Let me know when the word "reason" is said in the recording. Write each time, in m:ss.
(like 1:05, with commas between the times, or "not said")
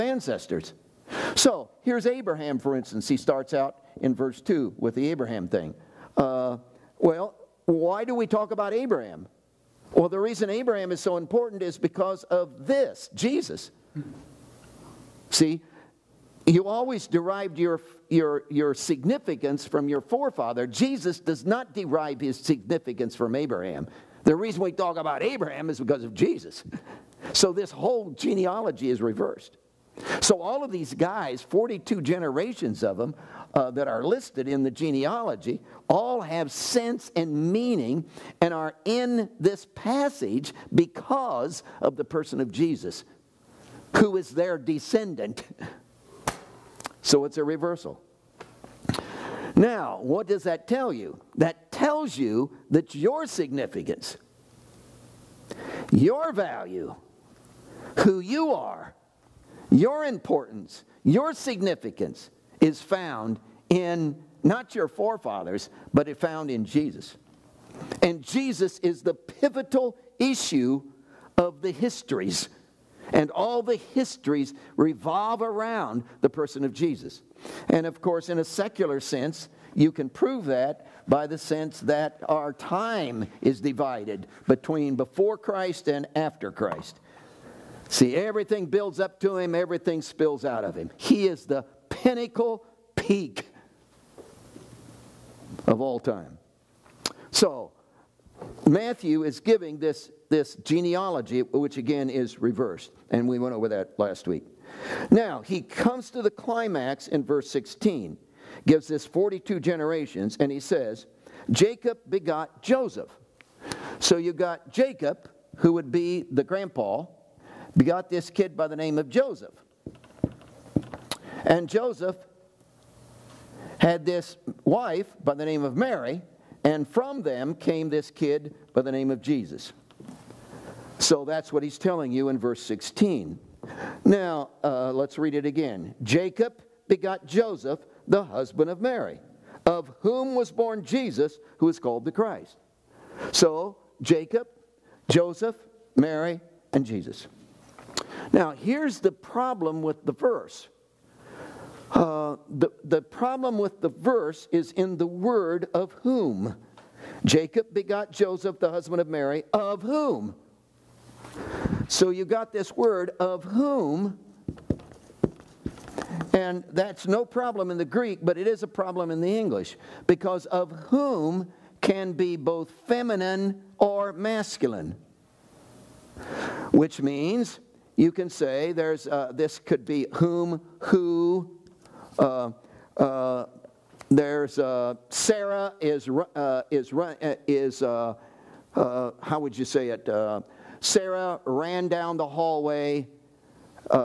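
0:10, 0:24.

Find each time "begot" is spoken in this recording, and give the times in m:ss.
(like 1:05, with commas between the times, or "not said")
1:52, 1:57, 2:16, 2:37.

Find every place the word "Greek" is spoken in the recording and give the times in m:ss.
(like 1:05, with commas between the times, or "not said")
2:47.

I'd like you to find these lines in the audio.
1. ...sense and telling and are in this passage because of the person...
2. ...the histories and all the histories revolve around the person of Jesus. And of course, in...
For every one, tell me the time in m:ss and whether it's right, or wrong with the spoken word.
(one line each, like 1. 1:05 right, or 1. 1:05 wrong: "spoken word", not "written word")
1. 0:36 wrong: "meaning", not "telling"
2. 1:11 right.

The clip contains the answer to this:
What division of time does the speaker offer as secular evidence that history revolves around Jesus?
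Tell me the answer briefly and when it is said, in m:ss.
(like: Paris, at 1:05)
Before Christ and after Christ, at 1:24.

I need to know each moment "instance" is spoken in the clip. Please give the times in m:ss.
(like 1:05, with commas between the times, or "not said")
0:02.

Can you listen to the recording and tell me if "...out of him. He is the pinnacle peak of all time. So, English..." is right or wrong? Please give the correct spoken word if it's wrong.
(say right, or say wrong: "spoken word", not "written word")
wrong: "Matthew", not "English".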